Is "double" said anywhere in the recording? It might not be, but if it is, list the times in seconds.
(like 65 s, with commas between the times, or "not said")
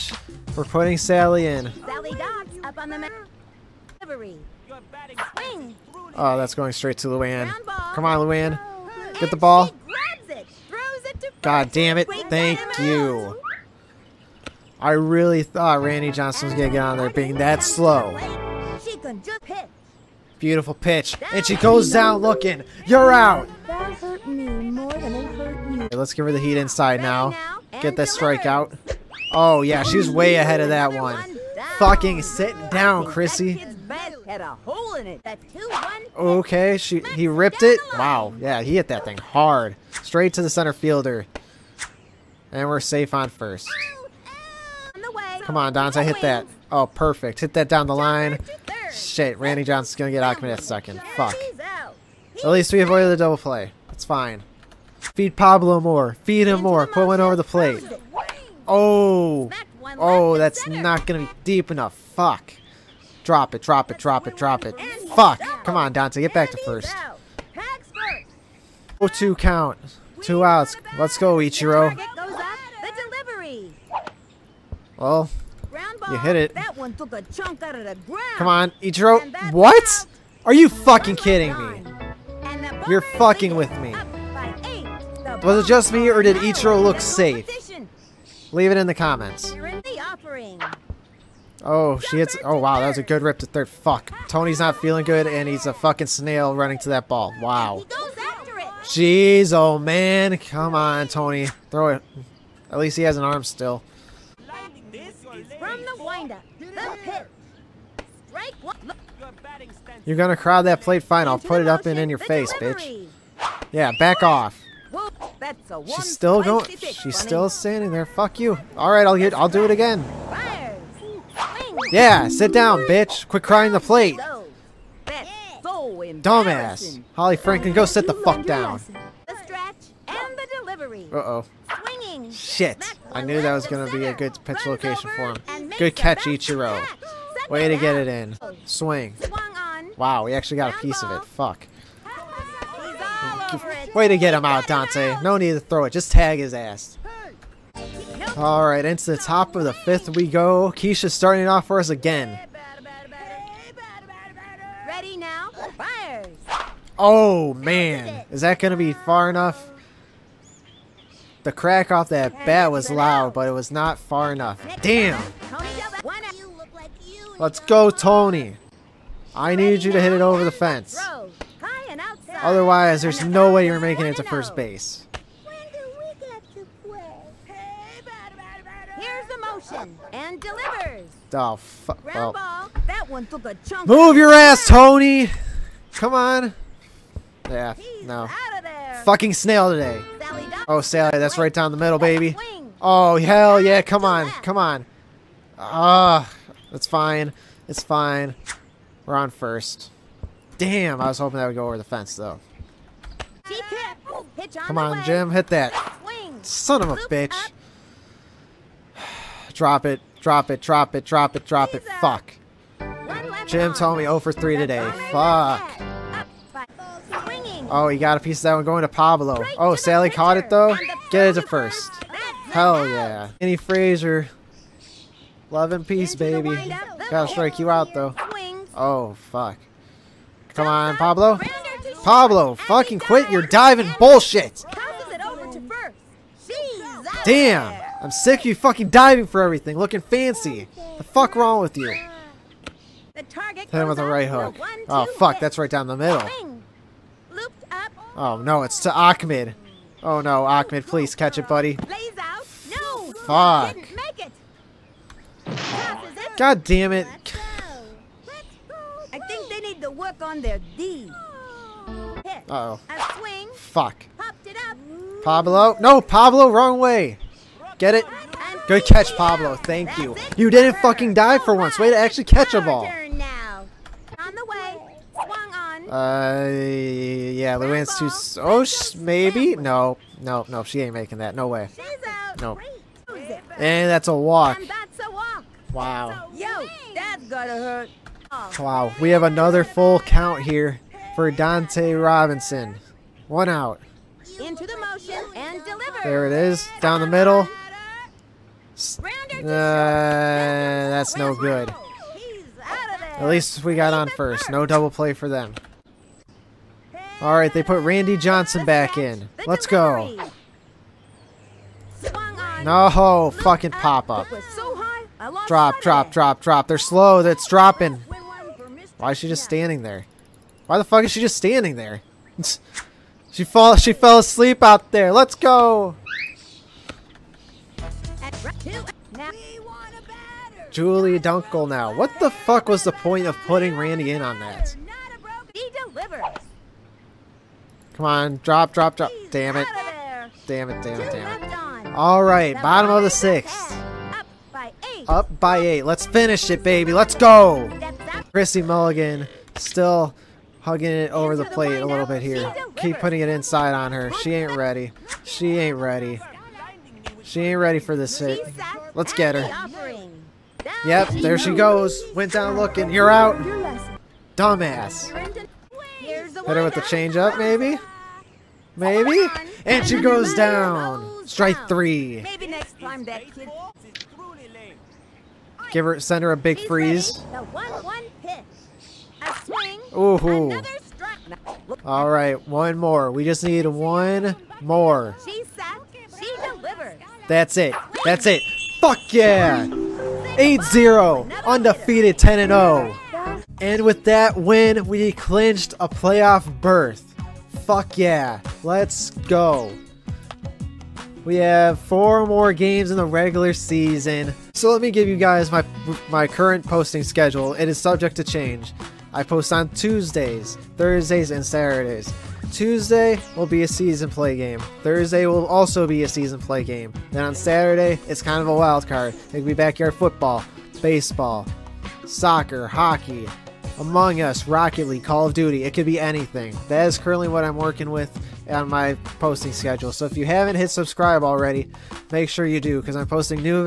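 53 s, 304 s.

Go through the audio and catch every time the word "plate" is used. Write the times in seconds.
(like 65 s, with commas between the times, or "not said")
57 s, 110 s, 123 s, 351 s.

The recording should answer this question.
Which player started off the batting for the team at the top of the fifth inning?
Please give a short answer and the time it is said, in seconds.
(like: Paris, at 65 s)
Keisha, at 150 s.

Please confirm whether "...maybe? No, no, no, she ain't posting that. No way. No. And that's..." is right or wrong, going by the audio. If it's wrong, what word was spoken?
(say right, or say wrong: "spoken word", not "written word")
wrong: "making", not "posting".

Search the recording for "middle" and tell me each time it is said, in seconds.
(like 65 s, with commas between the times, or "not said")
191 s, 245 s, 297 s.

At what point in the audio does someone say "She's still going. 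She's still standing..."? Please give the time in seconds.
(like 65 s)
115 s.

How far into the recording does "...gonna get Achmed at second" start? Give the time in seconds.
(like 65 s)
49 s.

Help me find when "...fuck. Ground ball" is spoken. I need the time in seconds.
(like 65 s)
181 s.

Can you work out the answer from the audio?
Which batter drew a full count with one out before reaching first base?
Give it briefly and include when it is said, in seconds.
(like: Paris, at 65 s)
Dante Robinson, at 291 s.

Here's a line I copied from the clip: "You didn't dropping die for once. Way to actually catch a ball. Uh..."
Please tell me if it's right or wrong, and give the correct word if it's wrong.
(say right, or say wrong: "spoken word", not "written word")
wrong: "fucking", not "dropping".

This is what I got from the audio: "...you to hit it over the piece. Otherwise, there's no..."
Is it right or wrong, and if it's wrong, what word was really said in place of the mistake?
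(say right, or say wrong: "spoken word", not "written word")
wrong: "fence", not "piece".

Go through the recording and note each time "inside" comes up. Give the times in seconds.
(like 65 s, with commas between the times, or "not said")
26 s, 353 s.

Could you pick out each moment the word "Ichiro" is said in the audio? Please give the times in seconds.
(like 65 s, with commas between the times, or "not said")
71 s, 78 s, 86 s, 136 s.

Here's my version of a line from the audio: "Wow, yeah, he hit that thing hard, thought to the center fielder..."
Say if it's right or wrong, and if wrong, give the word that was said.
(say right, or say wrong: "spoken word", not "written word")
wrong: "straight", not "thought".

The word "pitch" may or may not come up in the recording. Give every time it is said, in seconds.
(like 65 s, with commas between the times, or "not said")
20 s, 134 s.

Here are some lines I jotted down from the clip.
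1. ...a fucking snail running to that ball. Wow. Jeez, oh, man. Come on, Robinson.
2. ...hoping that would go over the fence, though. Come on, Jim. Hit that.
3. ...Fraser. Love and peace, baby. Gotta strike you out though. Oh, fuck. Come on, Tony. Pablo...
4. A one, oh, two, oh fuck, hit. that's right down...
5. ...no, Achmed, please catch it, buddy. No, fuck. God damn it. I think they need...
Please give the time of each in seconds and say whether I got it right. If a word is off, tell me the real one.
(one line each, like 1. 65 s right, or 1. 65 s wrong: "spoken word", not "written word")
1. 95 s wrong: "Tony", not "Robinson"
2. 201 s right
3. 223 s wrong: "Pablo", not "Tony"
4. 244 s right
5. 250 s right.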